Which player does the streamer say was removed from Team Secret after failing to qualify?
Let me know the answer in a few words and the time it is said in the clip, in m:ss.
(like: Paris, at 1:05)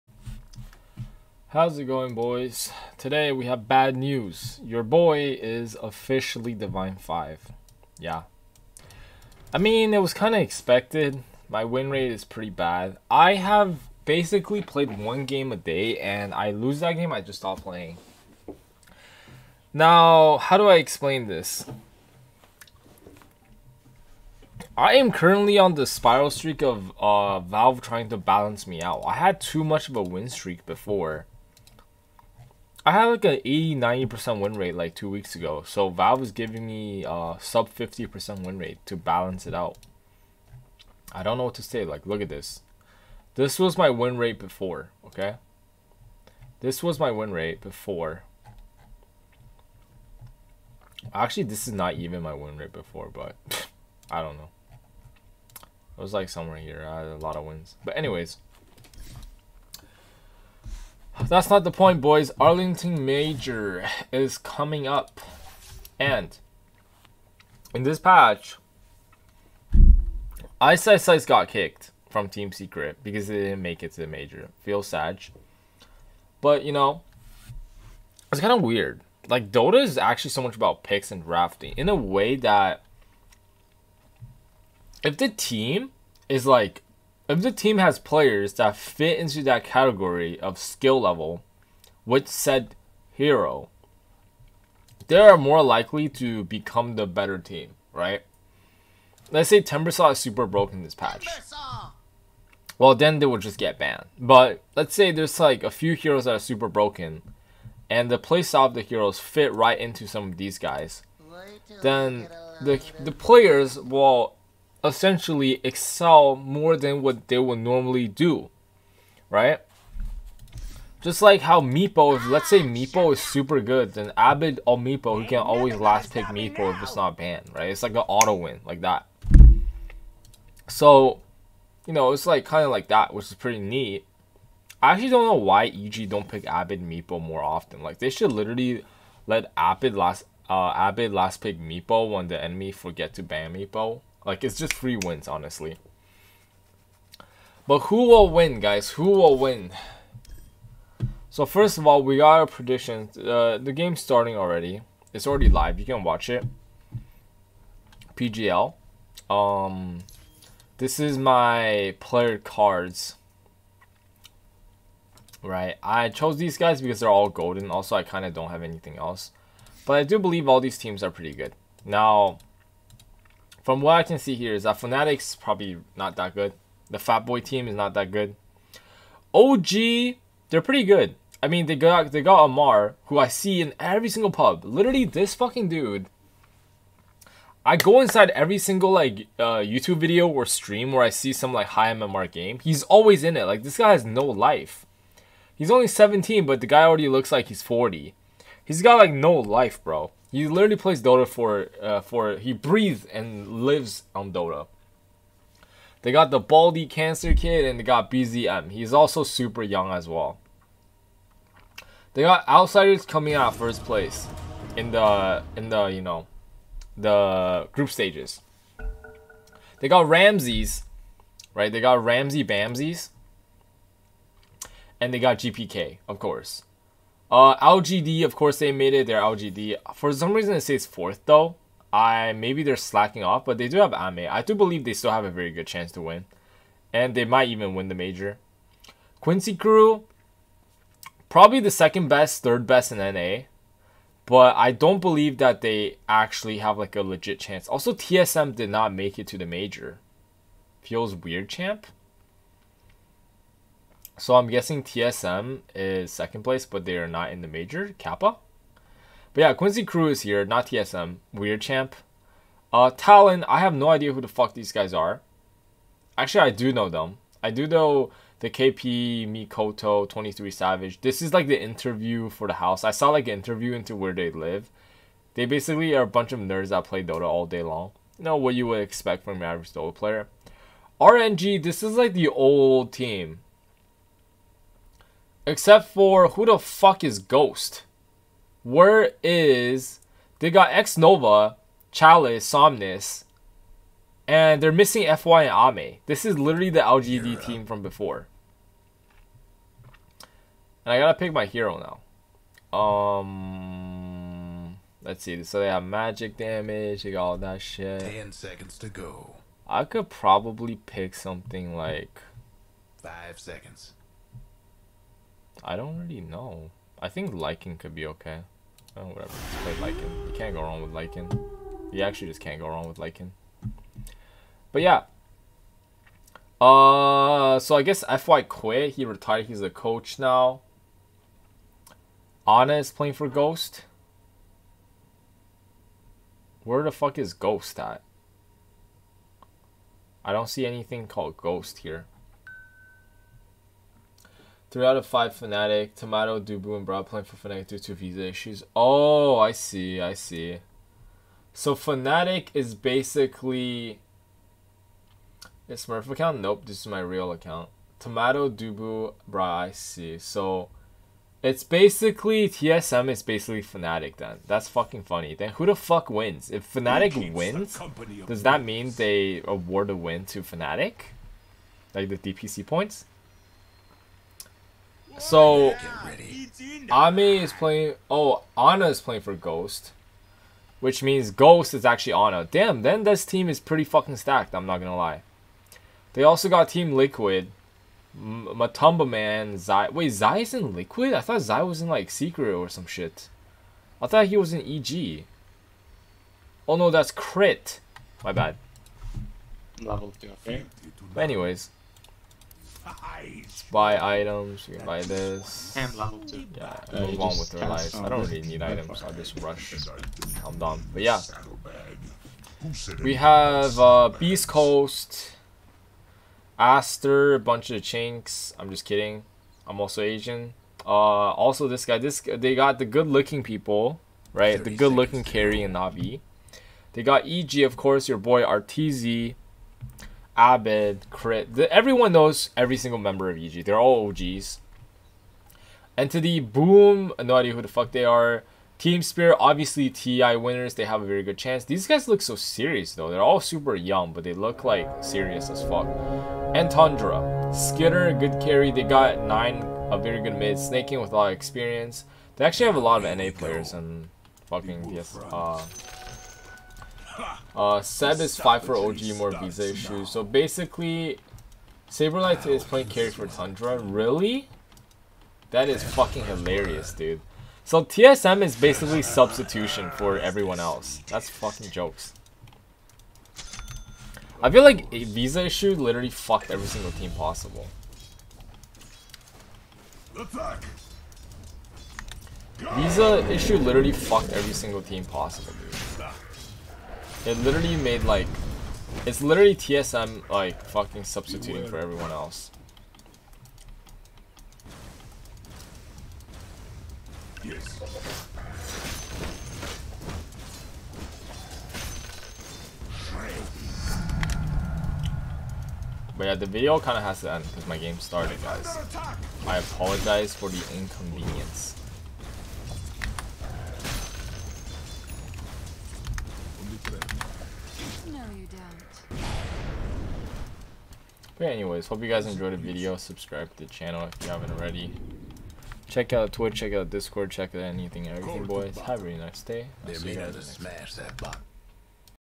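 Ice Ice Ice, at 1:10.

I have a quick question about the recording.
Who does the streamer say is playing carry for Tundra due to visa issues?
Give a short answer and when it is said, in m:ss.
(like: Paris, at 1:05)
Saberlight, at 7:41.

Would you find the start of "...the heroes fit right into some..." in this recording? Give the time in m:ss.
1:48.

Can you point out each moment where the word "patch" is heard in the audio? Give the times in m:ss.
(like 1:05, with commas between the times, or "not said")
1:07, 1:40.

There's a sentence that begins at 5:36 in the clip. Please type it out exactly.
Where the fuck is Ghost at?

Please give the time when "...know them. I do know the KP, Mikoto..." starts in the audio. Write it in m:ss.
4:26.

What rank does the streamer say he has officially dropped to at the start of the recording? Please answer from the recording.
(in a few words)
Divine 5.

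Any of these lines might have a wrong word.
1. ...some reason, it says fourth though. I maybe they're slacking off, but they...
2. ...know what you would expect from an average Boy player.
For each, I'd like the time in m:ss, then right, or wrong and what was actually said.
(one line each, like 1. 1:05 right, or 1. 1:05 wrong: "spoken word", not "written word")
1. 3:50 right
2. 4:38 wrong: "Dota", not "Boy".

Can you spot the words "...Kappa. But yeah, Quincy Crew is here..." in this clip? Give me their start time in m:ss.
4:17.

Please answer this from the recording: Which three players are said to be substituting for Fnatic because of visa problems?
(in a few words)
Tomato, Dubu, Bra.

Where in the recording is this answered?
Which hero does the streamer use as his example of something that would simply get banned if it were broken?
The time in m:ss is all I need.
1:39.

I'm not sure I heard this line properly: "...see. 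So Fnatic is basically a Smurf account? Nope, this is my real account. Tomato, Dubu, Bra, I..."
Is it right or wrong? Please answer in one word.
right.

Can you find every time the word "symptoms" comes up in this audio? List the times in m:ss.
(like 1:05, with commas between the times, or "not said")
not said.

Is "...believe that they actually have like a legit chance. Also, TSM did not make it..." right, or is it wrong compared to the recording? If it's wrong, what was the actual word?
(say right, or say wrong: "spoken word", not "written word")
right.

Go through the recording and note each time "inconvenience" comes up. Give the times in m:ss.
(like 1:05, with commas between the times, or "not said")
8:30.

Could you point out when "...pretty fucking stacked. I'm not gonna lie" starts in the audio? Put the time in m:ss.
6:23.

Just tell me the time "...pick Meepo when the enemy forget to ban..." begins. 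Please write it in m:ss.
2:21.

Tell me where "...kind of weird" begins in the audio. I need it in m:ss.
1:18.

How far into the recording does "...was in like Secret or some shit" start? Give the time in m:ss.
6:31.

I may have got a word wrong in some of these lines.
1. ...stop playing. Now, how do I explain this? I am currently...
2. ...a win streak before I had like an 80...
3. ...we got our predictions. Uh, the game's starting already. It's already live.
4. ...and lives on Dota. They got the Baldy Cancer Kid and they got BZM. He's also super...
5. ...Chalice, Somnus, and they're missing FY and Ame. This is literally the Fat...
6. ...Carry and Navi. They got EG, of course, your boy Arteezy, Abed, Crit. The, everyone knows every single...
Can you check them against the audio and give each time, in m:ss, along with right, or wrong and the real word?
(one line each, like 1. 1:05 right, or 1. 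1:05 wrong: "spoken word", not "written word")
1. 0:17 right
2. 0:29 right
3. 2:32 right
4. 3:23 right
5. 4:51 wrong: "LGD", not "Fat"
6. 7:05 right.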